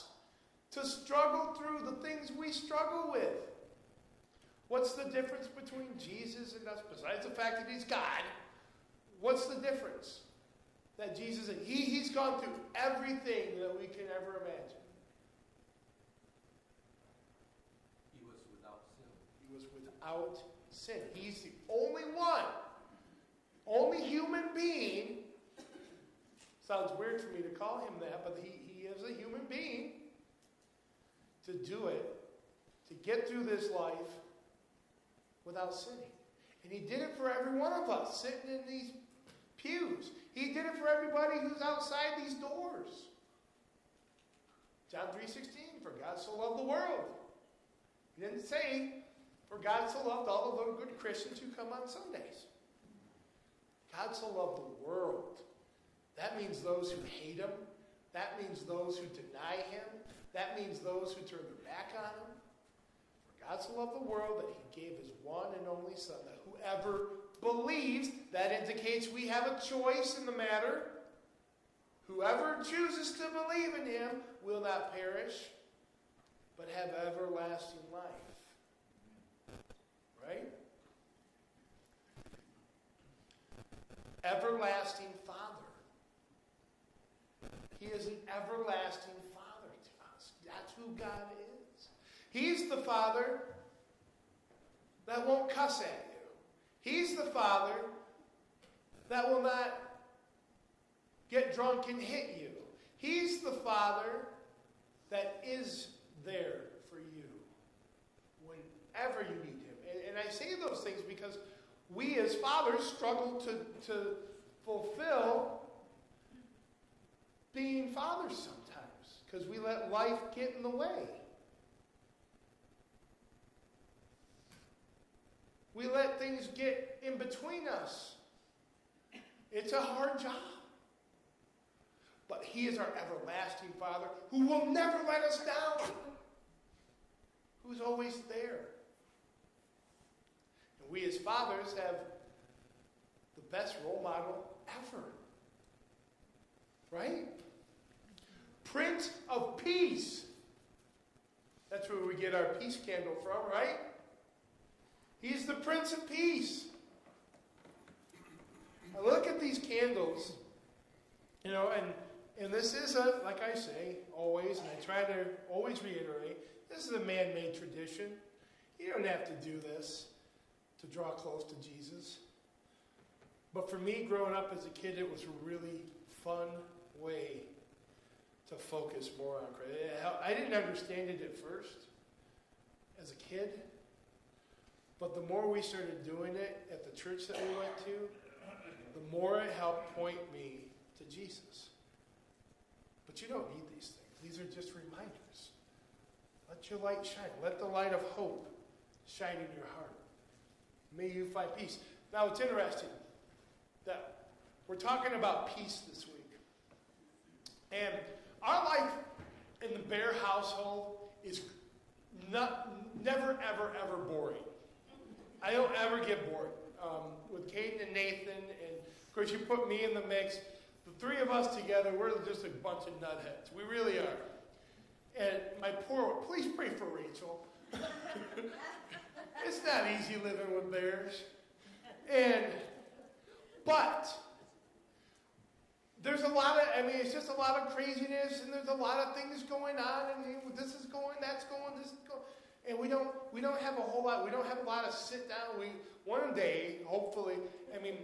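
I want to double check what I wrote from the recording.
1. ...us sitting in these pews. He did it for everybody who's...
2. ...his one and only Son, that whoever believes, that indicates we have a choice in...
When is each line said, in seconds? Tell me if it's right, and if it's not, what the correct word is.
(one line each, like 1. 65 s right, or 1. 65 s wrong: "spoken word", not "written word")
1. 37 s right
2. 64 s right.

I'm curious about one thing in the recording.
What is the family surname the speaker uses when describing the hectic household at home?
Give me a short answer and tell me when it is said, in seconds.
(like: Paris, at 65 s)
Behr, at 209 s.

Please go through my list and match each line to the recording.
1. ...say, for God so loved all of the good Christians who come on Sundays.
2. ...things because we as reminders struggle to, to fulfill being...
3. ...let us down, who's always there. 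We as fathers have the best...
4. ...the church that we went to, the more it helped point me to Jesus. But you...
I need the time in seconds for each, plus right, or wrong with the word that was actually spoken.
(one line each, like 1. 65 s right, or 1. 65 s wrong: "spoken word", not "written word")
1. 48 s right
2. 110 s wrong: "fathers", not "reminders"
3. 135 s right
4. 186 s right.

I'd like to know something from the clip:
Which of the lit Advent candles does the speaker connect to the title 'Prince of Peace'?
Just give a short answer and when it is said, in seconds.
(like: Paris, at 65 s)
peace candle, at 152 s.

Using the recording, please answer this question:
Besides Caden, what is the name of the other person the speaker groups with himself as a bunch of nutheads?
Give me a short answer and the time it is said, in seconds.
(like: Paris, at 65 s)
Nathan, at 217 s.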